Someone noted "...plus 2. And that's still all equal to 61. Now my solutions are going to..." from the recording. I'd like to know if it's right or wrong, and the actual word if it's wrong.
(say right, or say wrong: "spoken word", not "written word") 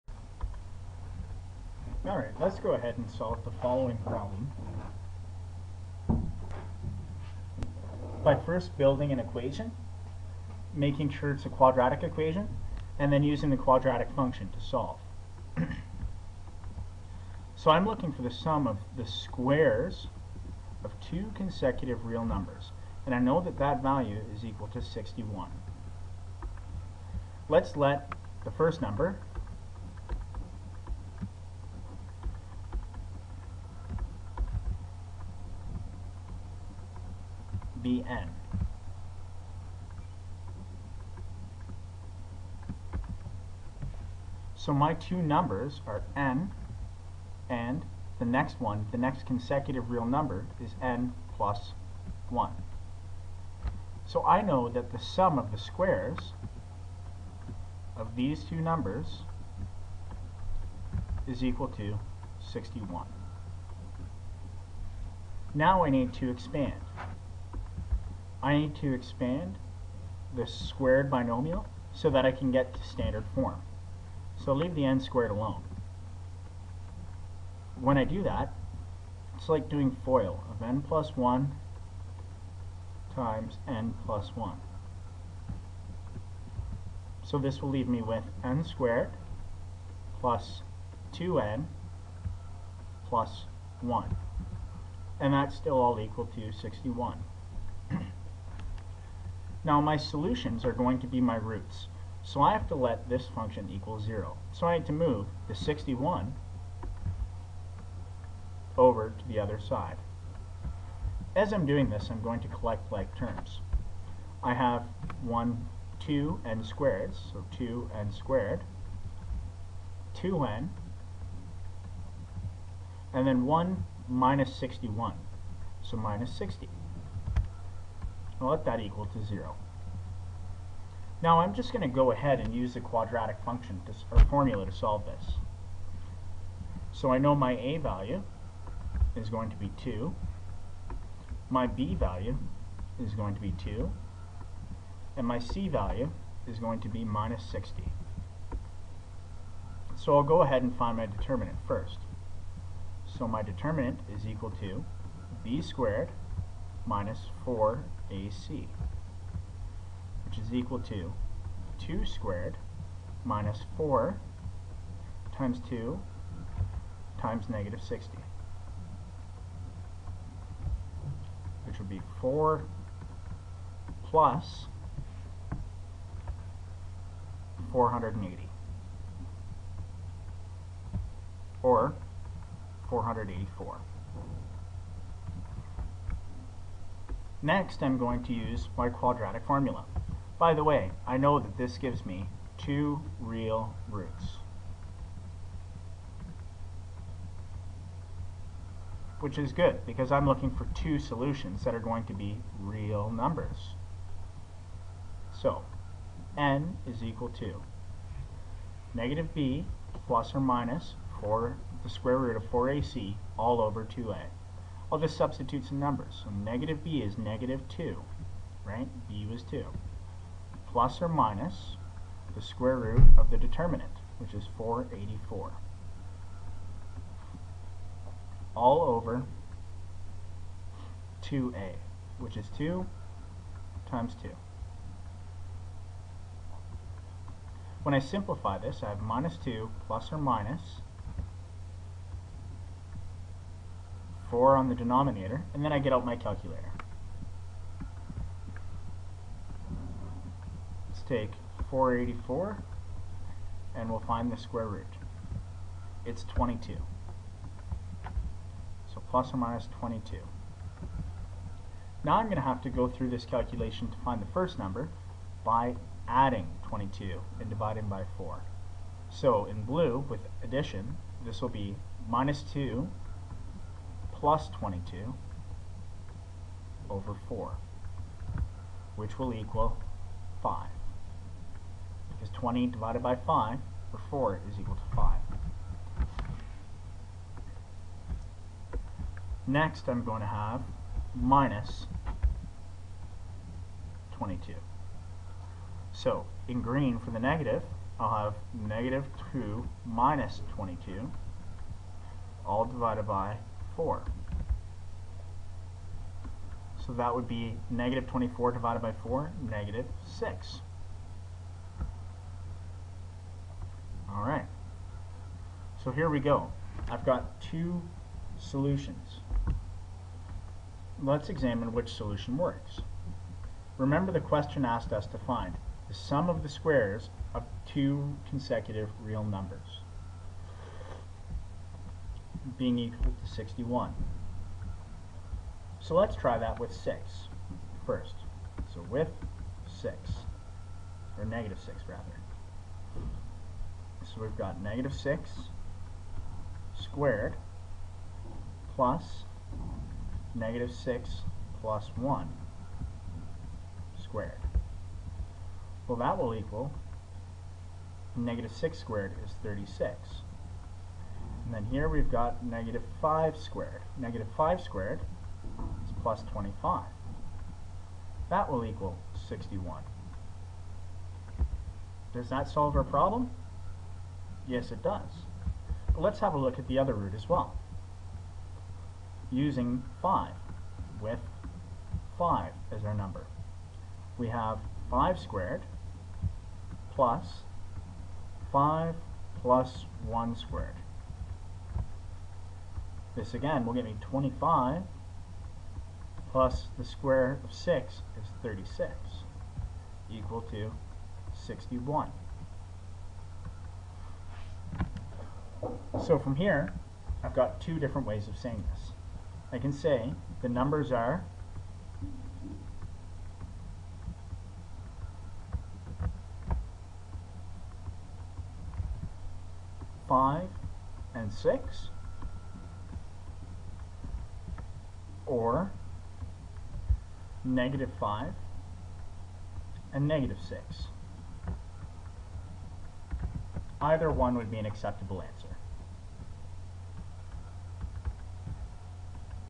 wrong: "1", not "2".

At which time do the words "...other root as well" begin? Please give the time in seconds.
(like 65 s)
376 s.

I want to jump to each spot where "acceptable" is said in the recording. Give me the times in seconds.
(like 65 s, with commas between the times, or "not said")
434 s.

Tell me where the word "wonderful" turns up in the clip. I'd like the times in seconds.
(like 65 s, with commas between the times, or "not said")
not said.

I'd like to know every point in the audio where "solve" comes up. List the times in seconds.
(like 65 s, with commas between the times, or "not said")
3 s, 14 s, 134 s, 372 s.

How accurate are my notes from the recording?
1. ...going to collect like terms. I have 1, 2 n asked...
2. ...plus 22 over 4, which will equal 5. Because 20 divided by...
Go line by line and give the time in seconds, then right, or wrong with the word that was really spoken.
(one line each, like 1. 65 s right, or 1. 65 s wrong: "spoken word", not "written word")
1. 112 s wrong: "squared", not "asked"
2. 274 s right.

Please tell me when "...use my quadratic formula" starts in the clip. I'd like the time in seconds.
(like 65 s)
188 s.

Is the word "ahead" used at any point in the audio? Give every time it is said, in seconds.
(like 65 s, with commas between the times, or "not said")
2 s, 132 s, 150 s.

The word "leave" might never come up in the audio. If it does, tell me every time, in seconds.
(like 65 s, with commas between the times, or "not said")
74 s, 87 s.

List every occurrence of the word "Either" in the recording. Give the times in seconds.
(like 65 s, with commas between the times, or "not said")
433 s.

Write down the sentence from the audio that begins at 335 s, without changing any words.
So let's try that with 6 first.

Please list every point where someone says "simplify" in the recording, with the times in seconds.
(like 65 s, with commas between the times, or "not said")
237 s.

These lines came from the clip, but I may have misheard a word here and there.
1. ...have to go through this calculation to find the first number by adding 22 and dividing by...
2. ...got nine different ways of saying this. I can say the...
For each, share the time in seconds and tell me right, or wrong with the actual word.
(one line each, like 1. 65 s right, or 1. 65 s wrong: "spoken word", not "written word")
1. 262 s right
2. 407 s wrong: "two", not "nine".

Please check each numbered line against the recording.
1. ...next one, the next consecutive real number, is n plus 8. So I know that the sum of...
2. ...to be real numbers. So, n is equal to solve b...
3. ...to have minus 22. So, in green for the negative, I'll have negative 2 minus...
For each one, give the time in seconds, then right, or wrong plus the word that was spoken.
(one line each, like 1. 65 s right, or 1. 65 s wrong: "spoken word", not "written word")
1. 48 s wrong: "1", not "8"
2. 202 s wrong: "negative", not "solve"
3. 290 s right.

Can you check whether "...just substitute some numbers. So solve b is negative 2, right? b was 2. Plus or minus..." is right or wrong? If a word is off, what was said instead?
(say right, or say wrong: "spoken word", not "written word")
wrong: "negative", not "solve".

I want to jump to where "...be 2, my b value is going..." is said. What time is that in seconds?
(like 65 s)
139 s.